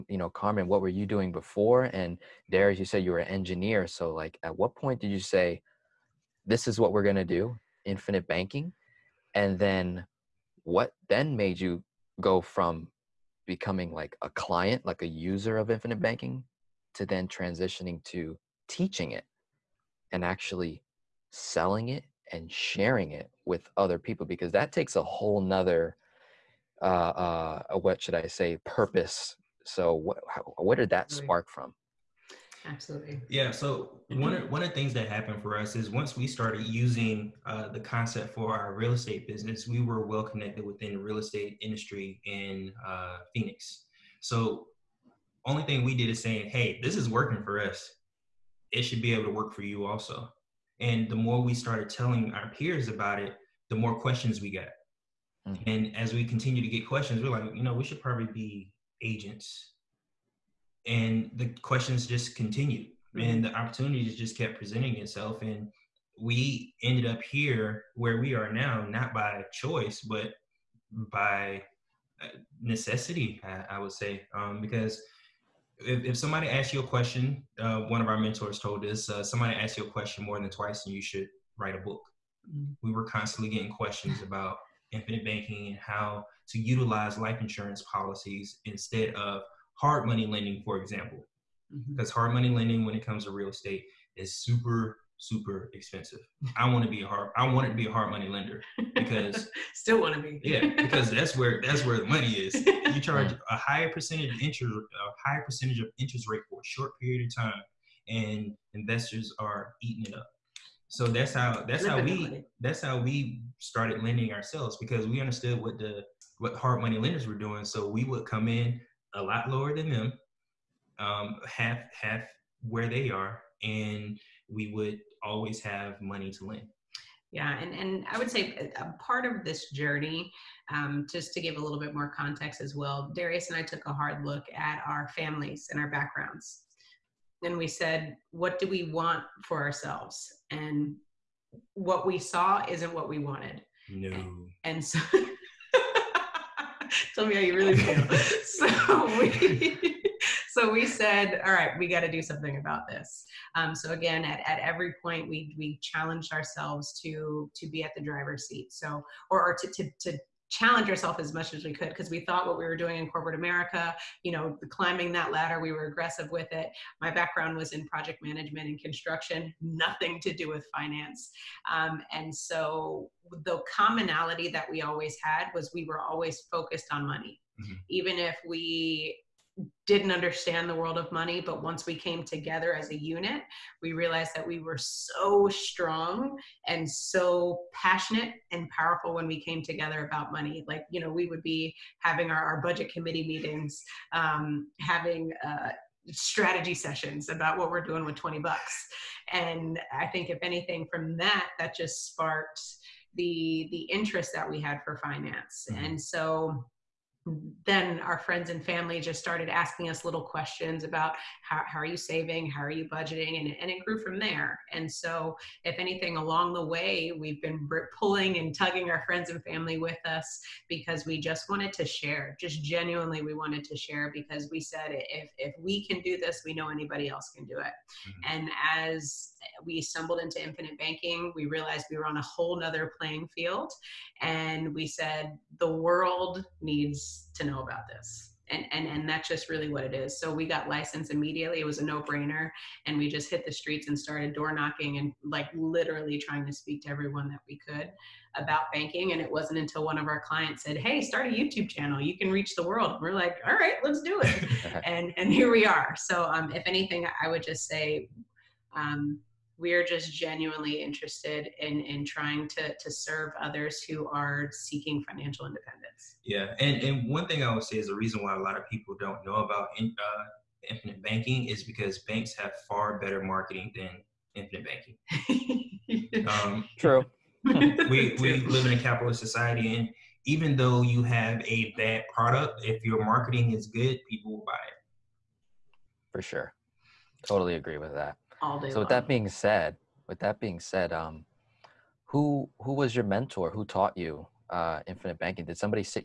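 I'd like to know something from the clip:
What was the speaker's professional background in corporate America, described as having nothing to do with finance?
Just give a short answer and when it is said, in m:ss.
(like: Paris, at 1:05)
Project management and construction, at 2:47.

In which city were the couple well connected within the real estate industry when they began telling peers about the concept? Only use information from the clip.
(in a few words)
Phoenix.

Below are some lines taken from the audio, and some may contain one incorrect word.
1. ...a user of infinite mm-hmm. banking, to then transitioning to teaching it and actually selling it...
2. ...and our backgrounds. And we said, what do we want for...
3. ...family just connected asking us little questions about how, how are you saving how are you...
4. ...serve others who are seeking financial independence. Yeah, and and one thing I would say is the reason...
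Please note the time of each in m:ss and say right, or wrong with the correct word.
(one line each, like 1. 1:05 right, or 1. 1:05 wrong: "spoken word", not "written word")
1. 0:15 right
2. 2:15 right
3. 3:28 wrong: "started", not "connected"
4. 4:22 right.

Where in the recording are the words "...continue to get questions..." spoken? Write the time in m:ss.
0:56.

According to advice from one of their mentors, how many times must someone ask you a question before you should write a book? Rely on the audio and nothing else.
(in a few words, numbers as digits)
More than twice.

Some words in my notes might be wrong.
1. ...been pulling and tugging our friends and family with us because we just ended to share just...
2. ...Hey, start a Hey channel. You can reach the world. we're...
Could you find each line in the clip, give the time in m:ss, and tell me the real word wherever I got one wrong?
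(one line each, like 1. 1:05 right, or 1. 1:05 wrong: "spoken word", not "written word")
1. 3:37 wrong: "wanted", not "ended"
2. 4:10 wrong: "YouTube", not "Hey".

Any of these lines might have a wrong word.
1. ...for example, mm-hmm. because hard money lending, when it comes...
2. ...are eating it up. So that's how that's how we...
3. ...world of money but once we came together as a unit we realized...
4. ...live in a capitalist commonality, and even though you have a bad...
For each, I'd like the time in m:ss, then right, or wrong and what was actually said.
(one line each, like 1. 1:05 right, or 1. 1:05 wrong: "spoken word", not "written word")
1. 1:30 right
2. 1:49 right
3. 3:00 right
4. 4:38 wrong: "society", not "commonality".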